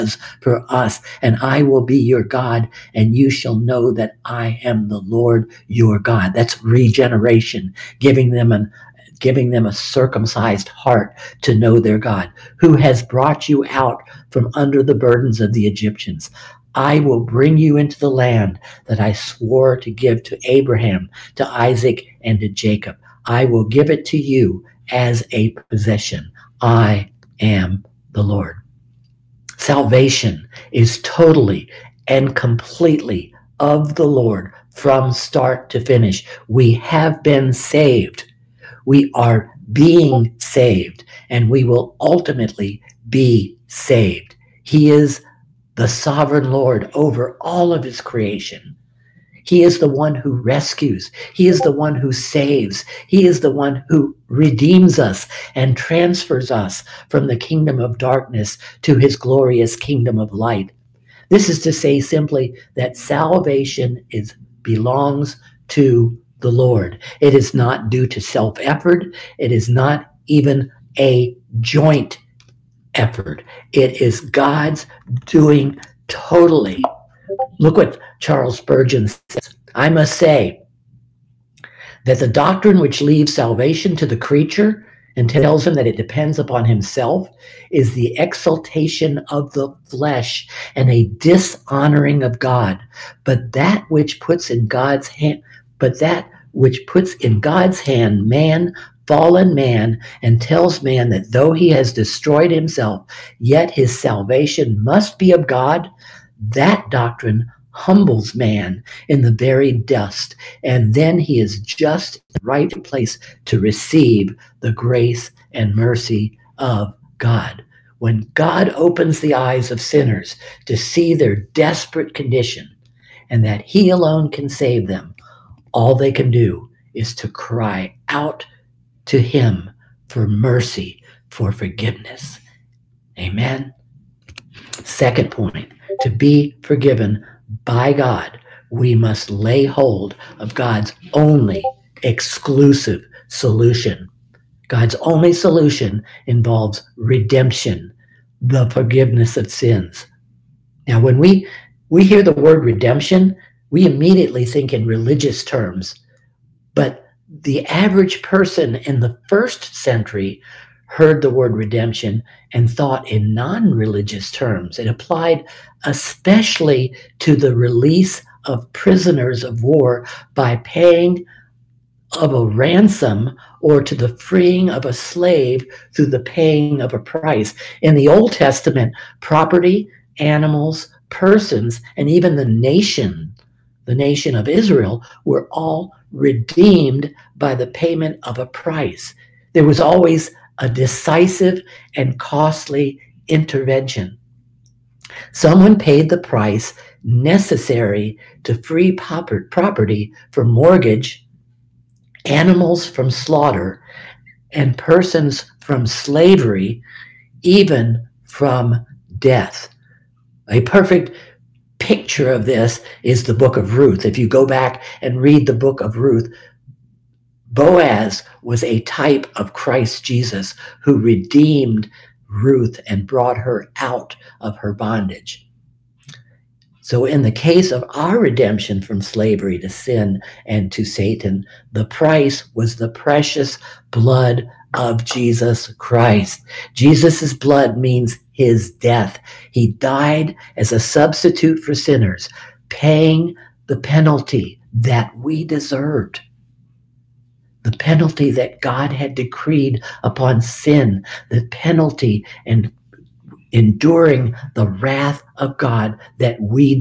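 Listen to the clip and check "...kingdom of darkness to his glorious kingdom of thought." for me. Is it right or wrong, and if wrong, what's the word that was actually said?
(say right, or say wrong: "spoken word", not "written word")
wrong: "light", not "thought".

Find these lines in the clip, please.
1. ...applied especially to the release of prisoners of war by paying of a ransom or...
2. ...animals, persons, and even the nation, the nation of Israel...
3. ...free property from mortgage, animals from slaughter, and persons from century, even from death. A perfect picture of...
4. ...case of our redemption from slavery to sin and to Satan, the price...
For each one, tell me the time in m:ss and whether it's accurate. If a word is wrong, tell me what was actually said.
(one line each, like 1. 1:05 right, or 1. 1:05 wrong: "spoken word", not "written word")
1. 2:44 right
2. 3:00 right
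3. 3:18 wrong: "slavery", not "century"
4. 3:47 right.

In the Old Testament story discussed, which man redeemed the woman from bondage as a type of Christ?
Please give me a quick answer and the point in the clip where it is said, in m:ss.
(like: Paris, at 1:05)
Boaz, at 3:37.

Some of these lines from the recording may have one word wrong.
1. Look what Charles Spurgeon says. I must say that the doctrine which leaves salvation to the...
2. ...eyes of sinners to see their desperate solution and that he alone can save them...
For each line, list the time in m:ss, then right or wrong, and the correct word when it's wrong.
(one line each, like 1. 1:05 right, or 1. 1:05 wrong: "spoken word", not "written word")
1. 1:17 right
2. 1:59 wrong: "condition", not "solution".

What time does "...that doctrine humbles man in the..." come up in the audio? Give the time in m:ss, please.
1:46.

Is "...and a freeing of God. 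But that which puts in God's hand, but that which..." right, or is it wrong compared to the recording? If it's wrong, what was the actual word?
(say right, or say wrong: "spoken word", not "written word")
wrong: "dishonoring", not "freeing".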